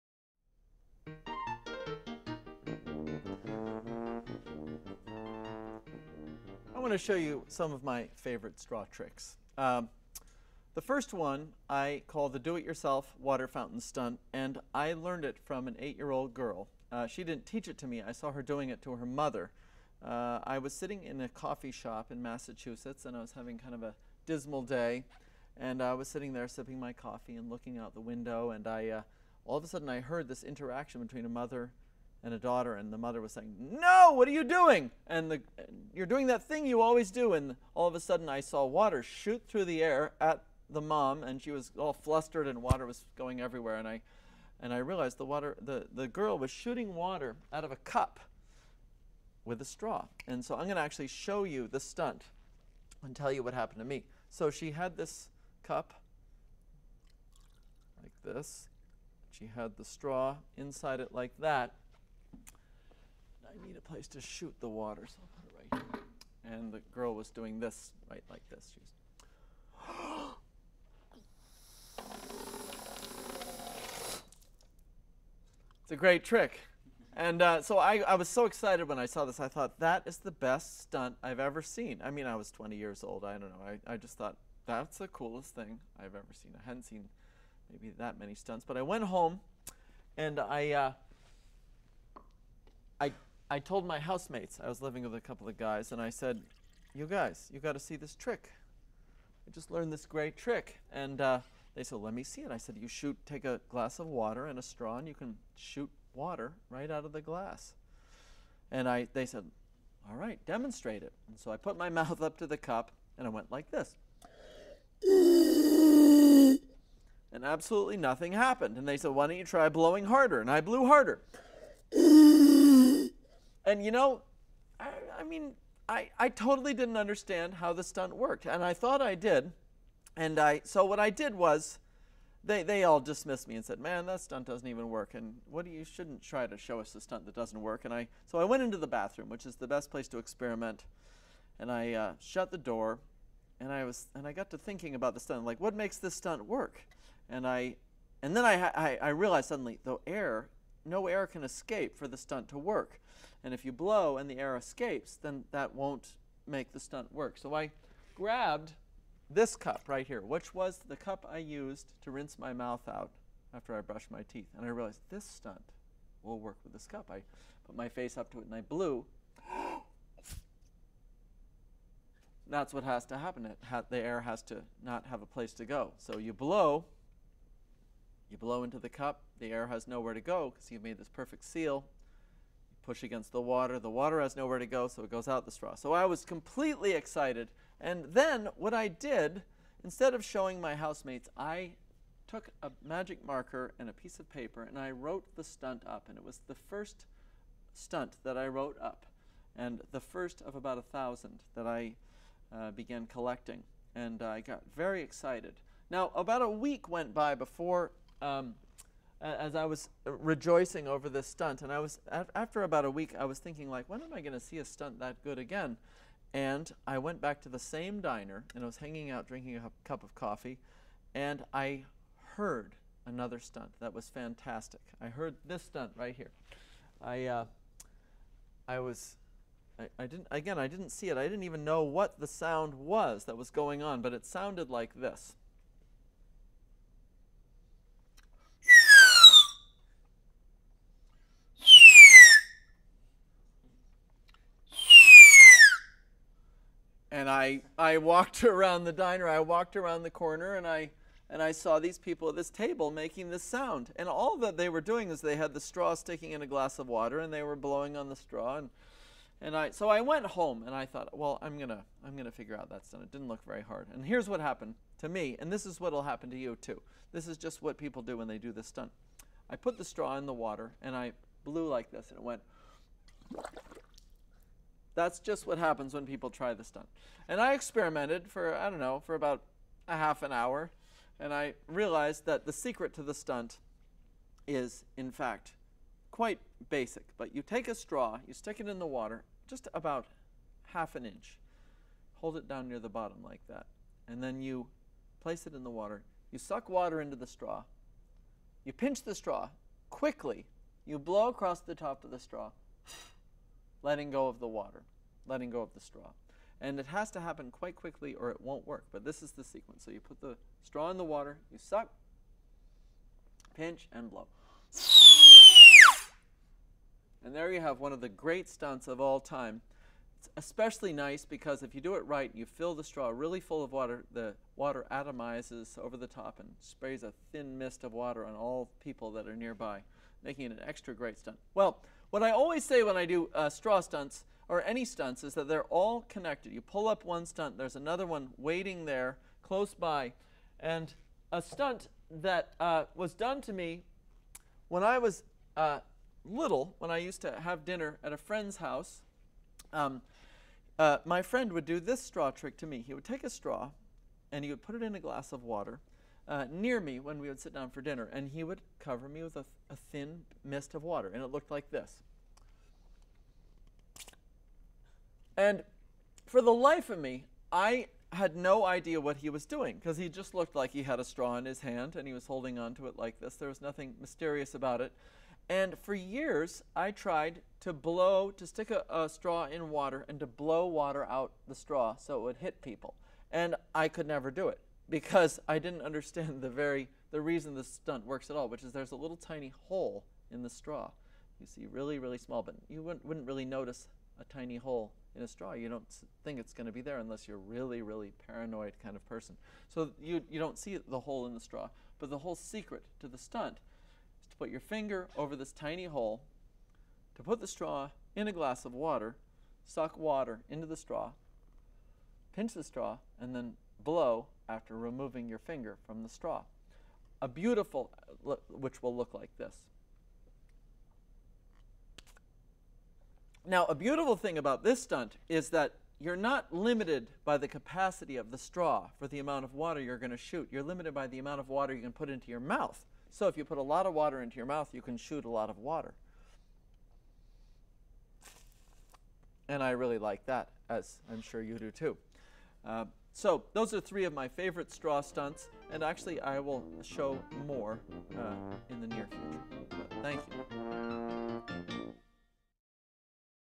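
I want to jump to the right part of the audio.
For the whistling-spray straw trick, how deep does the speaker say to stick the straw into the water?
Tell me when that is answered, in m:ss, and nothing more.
4:50.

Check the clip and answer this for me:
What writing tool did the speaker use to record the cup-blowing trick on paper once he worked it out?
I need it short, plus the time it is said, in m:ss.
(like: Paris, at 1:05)
magic marker, at 3:12.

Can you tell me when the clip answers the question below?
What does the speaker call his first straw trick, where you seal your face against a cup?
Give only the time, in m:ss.
0:12.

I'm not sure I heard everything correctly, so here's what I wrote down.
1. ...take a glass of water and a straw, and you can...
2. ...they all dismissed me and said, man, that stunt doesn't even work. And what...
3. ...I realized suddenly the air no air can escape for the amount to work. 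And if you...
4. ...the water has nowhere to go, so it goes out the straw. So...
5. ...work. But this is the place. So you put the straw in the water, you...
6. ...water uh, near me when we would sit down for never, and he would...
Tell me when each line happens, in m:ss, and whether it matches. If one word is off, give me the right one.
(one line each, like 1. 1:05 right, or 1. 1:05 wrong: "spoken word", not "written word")
1. 1:43 right
2. 2:12 right
3. 2:29 wrong: "stunt", not "amount"
4. 3:03 right
5. 5:08 wrong: "sequence", not "place"
6. 5:55 wrong: "dinner", not "never".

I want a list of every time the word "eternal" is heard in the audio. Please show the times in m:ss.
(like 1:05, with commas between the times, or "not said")
not said.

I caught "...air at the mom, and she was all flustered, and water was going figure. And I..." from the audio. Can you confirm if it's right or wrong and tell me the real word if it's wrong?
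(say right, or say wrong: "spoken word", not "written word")
wrong: "everywhere", not "figure".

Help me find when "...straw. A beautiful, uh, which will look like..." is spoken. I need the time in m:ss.
6:56.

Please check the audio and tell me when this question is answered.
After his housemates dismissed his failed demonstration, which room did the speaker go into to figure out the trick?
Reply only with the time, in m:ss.
2:18.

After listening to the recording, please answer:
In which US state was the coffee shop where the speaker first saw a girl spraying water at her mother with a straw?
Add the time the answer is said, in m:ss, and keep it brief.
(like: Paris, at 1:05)
Massachusetts, at 0:22.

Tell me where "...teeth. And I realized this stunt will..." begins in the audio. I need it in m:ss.
2:44.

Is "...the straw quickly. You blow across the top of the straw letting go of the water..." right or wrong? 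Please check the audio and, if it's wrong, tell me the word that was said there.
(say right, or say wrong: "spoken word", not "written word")
right.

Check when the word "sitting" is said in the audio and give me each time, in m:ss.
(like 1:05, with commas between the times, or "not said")
0:20, 0:26.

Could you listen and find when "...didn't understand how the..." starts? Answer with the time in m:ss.
2:06.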